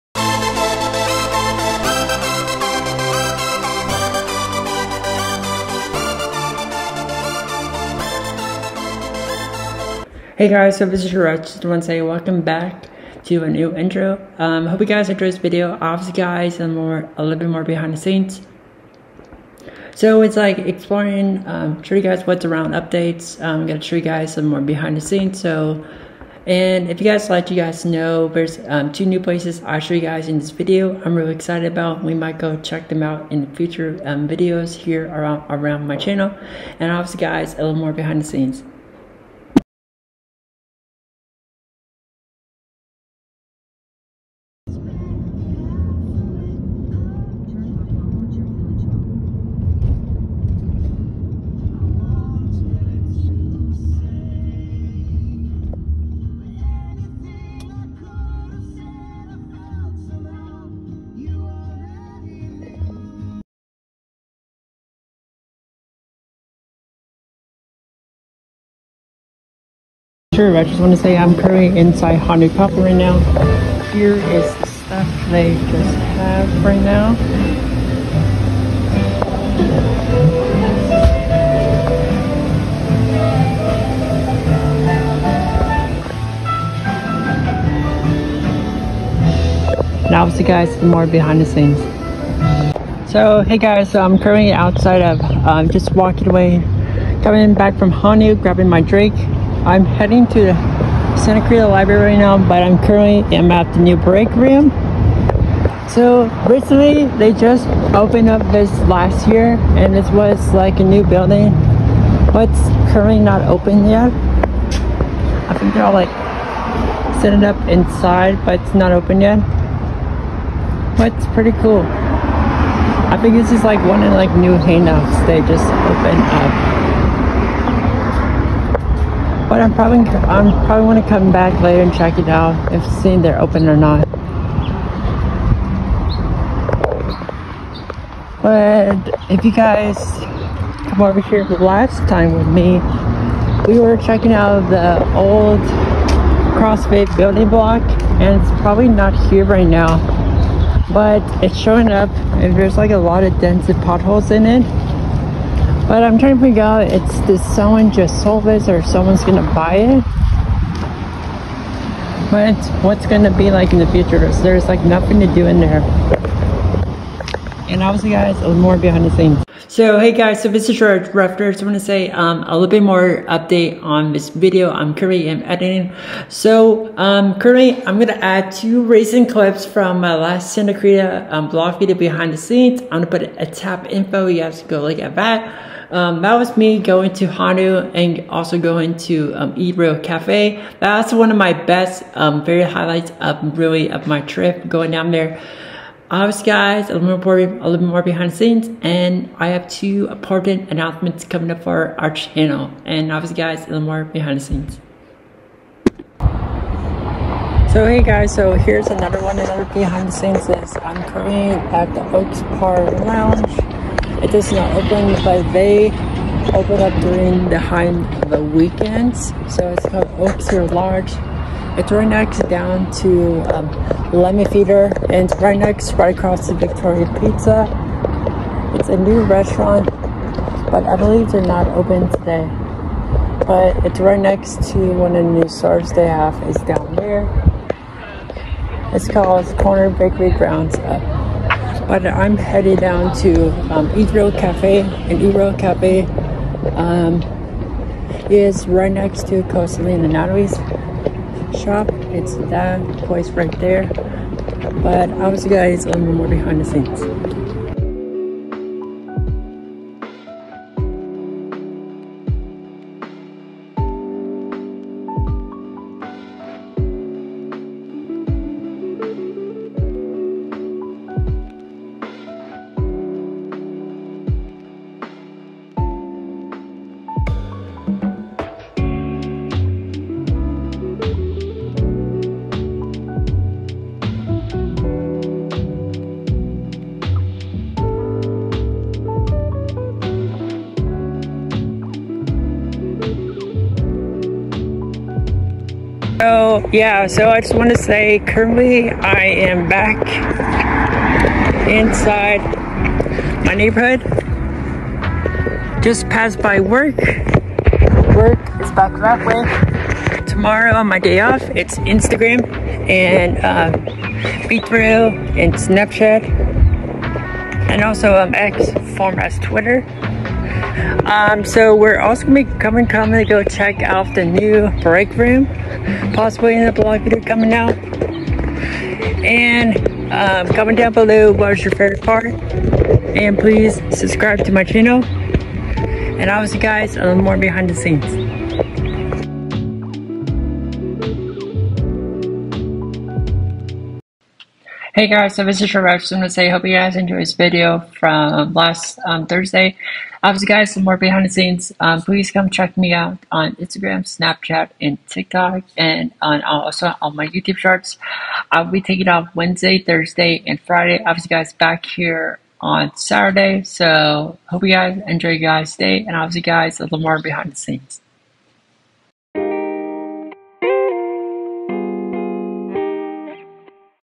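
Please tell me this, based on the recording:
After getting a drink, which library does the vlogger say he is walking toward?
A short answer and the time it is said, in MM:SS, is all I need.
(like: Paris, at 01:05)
Santa Cruz Library, at 01:40.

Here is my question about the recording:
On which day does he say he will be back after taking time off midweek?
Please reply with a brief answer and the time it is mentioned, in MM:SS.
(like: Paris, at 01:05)
Saturday, at 06:02.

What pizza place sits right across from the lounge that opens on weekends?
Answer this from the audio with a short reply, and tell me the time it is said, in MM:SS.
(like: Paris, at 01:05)
Victoria Pizza, at 03:46.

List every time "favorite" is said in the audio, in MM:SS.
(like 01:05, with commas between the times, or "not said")
05:31.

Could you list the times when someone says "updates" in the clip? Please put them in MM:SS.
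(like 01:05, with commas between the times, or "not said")
00:22, 02:53.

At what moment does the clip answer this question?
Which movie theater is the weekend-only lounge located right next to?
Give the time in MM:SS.
03:44.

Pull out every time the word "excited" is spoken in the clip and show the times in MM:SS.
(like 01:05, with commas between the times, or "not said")
00:31.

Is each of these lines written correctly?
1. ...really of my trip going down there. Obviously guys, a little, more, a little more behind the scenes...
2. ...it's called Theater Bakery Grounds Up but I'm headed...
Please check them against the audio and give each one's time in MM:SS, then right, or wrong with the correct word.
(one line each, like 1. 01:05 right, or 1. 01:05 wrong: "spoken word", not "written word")
1. 03:13 right
2. 03:58 wrong: "Corner", not "Theater".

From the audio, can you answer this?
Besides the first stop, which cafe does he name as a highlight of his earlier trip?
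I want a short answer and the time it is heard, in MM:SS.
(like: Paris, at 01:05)
Ebro Cafe, at 03:09.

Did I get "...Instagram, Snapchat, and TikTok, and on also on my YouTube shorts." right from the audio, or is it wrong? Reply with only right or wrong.
right.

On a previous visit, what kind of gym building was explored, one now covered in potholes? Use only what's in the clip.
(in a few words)
CrossFit.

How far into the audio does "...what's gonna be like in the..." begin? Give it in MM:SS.
02:42.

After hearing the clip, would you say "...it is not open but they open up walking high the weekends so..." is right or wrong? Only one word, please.
wrong.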